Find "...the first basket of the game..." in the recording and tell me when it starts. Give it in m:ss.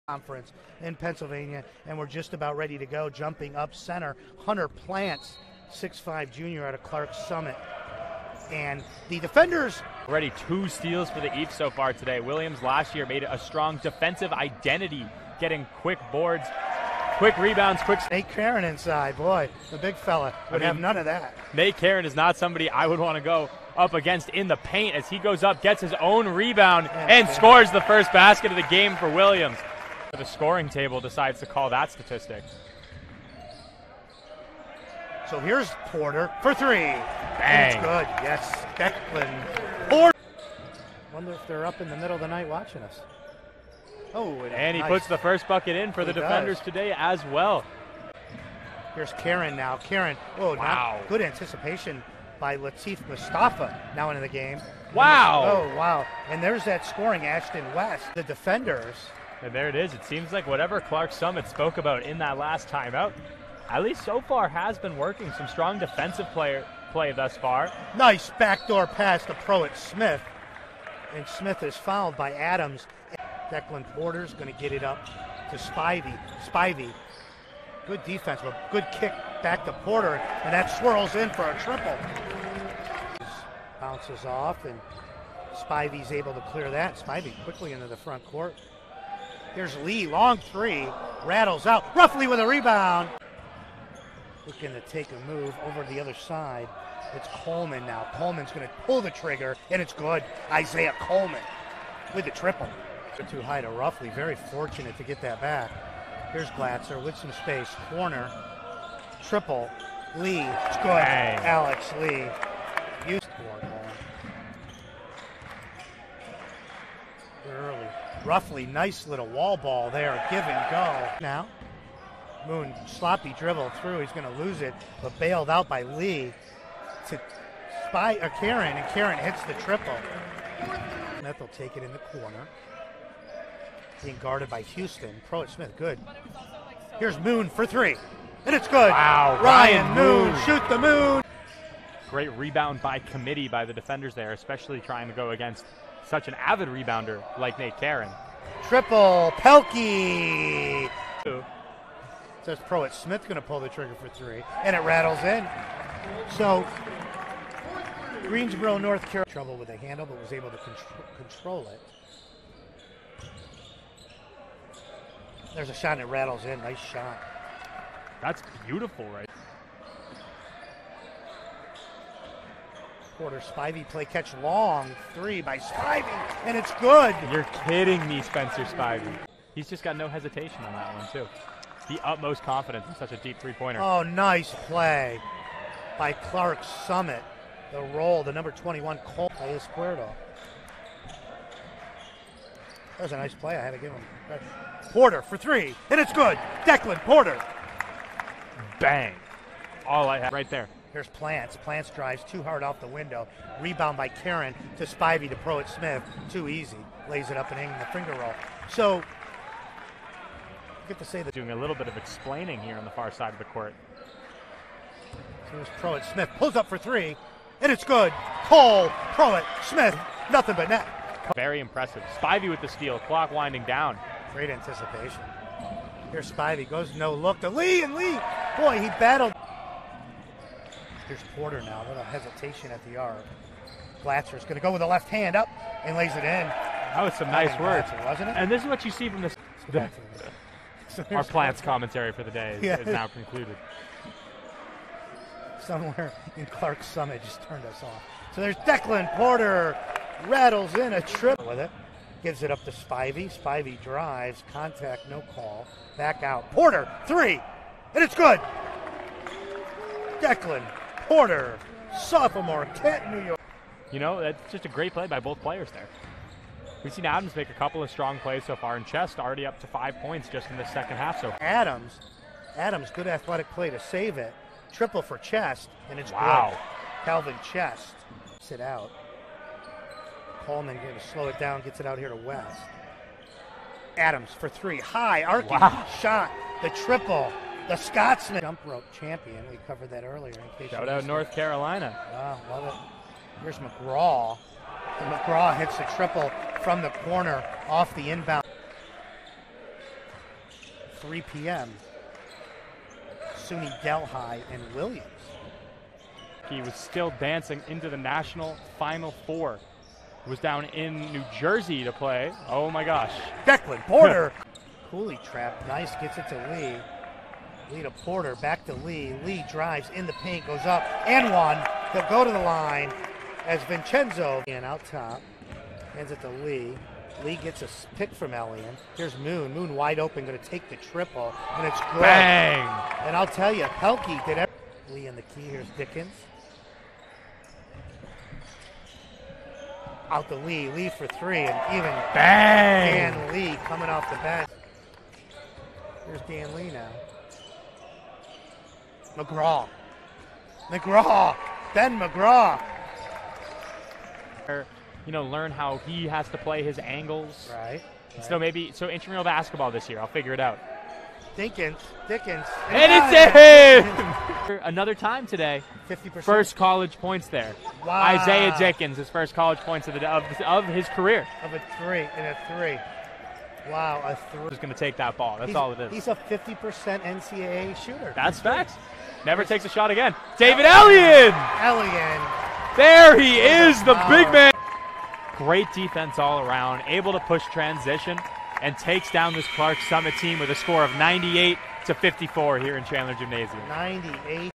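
0:27.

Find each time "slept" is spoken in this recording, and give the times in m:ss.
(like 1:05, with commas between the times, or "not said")
not said.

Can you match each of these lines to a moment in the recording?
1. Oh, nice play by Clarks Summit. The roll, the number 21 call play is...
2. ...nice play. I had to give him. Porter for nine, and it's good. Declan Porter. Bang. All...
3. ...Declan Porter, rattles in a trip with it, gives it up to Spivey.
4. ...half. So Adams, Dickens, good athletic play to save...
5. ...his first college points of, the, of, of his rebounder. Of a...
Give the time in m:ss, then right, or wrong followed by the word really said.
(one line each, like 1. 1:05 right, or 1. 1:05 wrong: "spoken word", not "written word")
1. 3:03 right
2. 3:13 wrong: "three", not "nine"
3. 4:08 right
4. 4:30 wrong: "Adams", not "Dickens"
5. 6:08 wrong: "career", not "rebounder".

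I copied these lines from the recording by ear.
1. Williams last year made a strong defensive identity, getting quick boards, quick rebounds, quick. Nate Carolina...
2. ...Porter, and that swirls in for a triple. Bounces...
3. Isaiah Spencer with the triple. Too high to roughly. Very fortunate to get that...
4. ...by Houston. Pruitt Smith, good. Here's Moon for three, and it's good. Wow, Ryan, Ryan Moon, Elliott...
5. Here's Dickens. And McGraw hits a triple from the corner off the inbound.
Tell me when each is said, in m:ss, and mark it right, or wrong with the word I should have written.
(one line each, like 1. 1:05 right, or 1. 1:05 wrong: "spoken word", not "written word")
1. 0:12 wrong: "Karen", not "Carolina"
2. 1:19 right
3. 1:40 wrong: "Coleman", not "Spencer"
4. 2:14 wrong: "Moon", not "Elliott"
5. 4:53 wrong: "McGraw", not "Dickens".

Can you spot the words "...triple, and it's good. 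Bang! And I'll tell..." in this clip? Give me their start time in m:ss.
5:30.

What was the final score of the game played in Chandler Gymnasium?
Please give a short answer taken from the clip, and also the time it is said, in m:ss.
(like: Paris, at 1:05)
98 to 54, at 6:30.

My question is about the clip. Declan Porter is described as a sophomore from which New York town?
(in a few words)
Kent.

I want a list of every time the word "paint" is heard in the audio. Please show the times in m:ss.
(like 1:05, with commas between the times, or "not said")
0:24, 5:20.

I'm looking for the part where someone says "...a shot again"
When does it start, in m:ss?
6:19.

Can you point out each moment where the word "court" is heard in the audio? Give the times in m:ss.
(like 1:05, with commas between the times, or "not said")
1:28, 3:33.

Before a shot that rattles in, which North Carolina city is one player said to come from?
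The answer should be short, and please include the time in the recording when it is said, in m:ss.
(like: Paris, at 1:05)
Greensboro, at 2:38.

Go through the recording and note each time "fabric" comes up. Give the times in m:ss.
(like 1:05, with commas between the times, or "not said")
not said.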